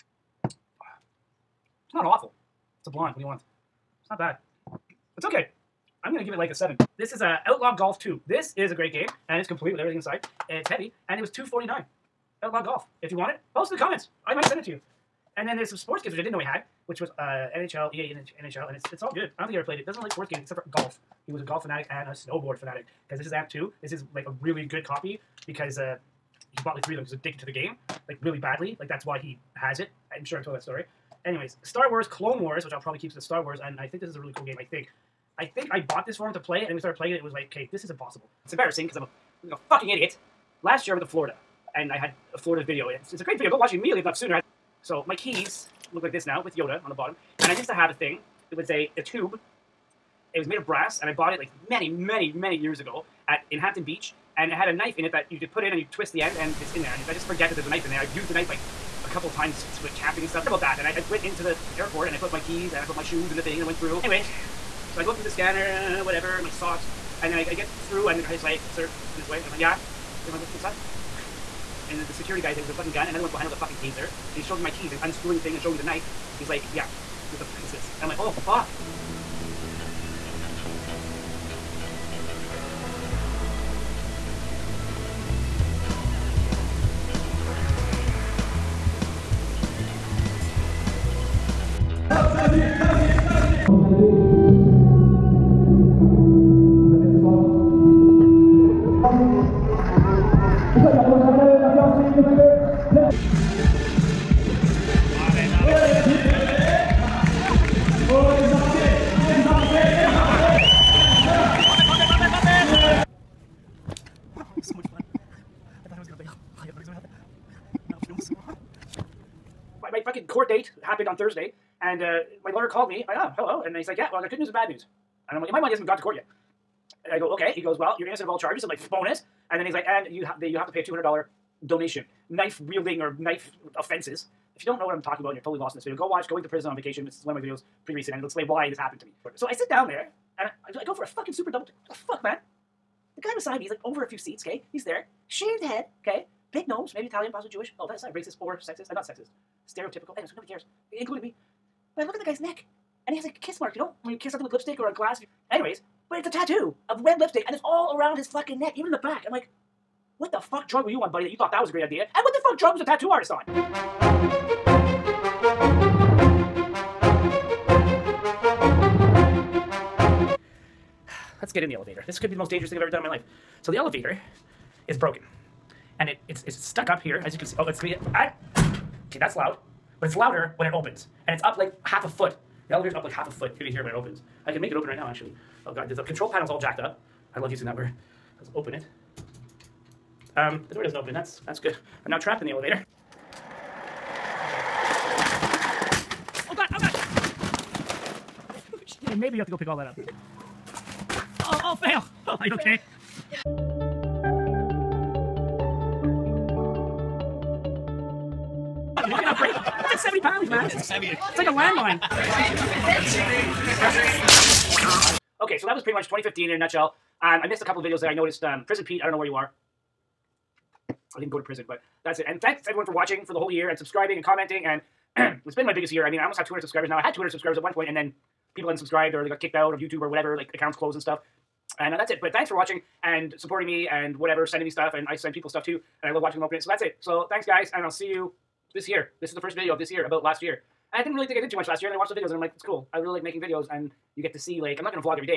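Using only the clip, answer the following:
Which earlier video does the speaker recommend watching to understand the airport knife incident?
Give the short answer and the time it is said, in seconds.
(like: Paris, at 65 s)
Going to Prison on Vacation, at 136 s.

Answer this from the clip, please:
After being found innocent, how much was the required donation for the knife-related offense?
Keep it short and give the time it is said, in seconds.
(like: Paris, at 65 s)
$200, at 130 s.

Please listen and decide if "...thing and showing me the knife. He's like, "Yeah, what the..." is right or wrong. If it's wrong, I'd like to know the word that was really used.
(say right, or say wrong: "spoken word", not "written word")
right.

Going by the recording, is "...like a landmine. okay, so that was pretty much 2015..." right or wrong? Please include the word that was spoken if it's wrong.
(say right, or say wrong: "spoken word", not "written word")
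right.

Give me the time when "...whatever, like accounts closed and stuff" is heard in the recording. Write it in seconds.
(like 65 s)
230 s.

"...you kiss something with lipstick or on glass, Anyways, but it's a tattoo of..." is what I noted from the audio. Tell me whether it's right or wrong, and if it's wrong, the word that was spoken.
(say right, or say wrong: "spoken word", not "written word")
right.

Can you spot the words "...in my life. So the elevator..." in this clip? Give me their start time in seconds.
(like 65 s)
172 s.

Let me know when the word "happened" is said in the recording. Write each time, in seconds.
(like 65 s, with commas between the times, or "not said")
120 s, 138 s.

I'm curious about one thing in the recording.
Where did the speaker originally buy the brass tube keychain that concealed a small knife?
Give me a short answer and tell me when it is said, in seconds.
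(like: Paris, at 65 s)
Hampton Beach, at 53 s.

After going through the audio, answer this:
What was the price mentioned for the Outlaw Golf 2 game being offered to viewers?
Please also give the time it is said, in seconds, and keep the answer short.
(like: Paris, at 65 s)
249, at 11 s.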